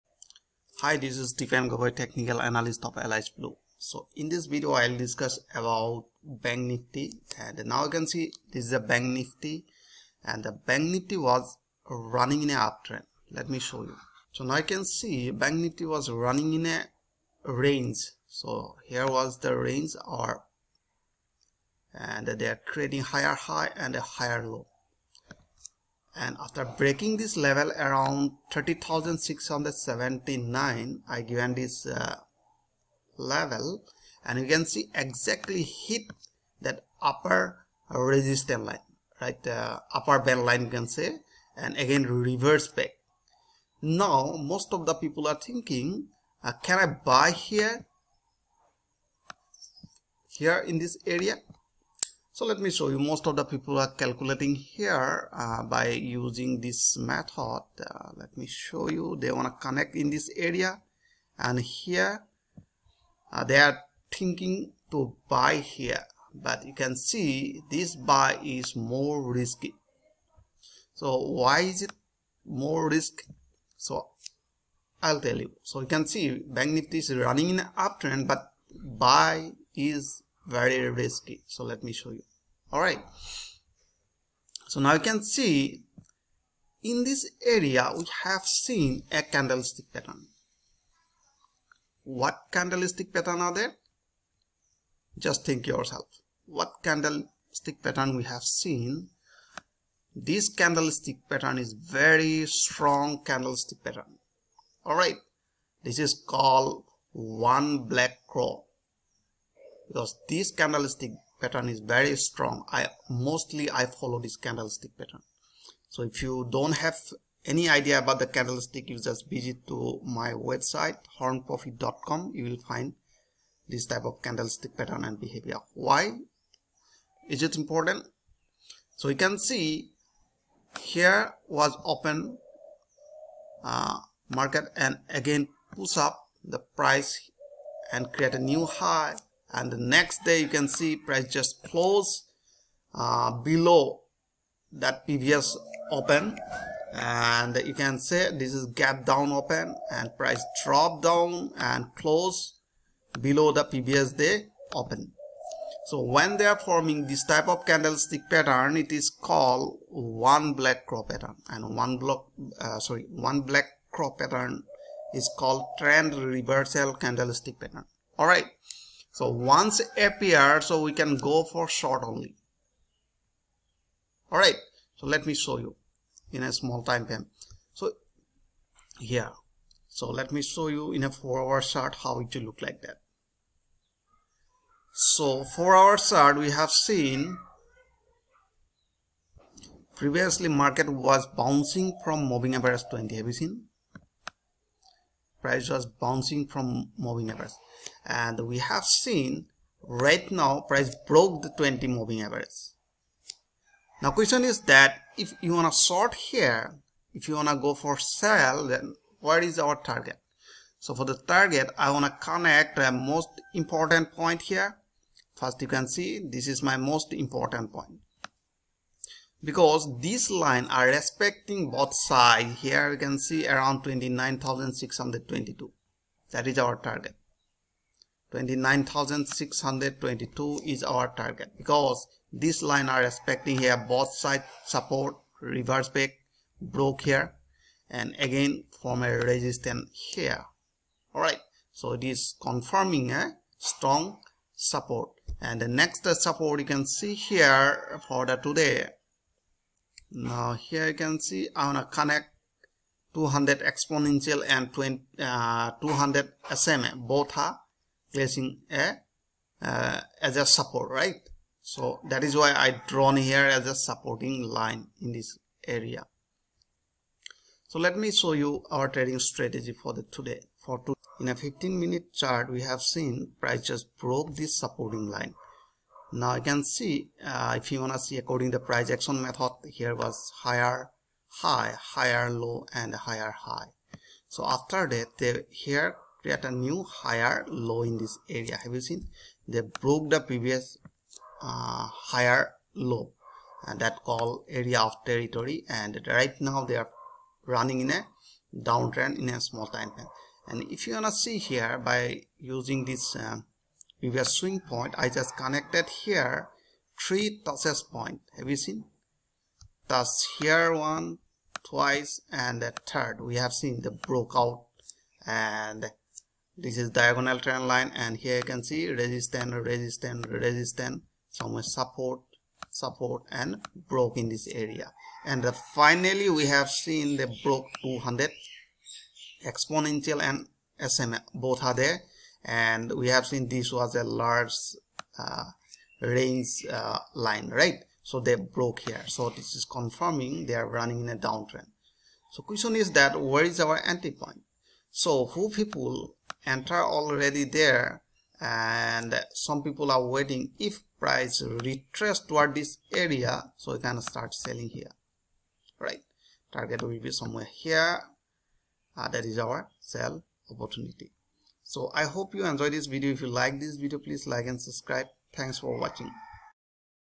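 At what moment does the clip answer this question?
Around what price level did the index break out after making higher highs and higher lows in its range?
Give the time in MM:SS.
00:28.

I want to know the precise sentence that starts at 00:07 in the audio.
And now you can see this is a Bank Nifty and the Bank Nifty was running in a uptrend.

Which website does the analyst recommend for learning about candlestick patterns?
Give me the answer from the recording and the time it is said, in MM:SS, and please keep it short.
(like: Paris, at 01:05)
hornprofit.com, at 02:01.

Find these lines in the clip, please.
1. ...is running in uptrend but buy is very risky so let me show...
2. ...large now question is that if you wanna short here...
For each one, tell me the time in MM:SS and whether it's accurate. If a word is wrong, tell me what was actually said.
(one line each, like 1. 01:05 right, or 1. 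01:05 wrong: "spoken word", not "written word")
1. 01:16 right
2. 03:22 wrong: "average", not "large".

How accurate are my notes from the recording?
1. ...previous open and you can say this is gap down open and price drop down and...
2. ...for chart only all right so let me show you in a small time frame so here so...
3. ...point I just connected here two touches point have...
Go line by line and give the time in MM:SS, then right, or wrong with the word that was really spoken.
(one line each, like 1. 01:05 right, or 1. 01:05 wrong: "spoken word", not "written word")
1. 02:25 right
2. 02:51 wrong: "short", not "chart"
3. 05:04 wrong: "three", not "two".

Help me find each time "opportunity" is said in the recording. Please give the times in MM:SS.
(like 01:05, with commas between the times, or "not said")
06:00.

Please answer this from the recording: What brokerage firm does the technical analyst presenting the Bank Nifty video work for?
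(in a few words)
Alice Blue.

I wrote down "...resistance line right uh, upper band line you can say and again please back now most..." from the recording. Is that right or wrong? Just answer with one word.
wrong.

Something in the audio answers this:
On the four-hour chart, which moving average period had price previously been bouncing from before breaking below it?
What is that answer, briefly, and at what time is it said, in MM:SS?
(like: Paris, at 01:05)
20, at 03:12.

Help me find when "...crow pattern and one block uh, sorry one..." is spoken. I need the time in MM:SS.
02:40.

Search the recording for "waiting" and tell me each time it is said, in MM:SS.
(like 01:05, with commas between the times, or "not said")
05:50.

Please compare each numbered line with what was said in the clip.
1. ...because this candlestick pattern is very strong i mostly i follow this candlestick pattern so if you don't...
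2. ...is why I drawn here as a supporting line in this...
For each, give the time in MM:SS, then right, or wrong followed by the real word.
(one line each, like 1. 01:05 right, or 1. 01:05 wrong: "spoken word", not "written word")
1. 01:49 right
2. 04:22 right.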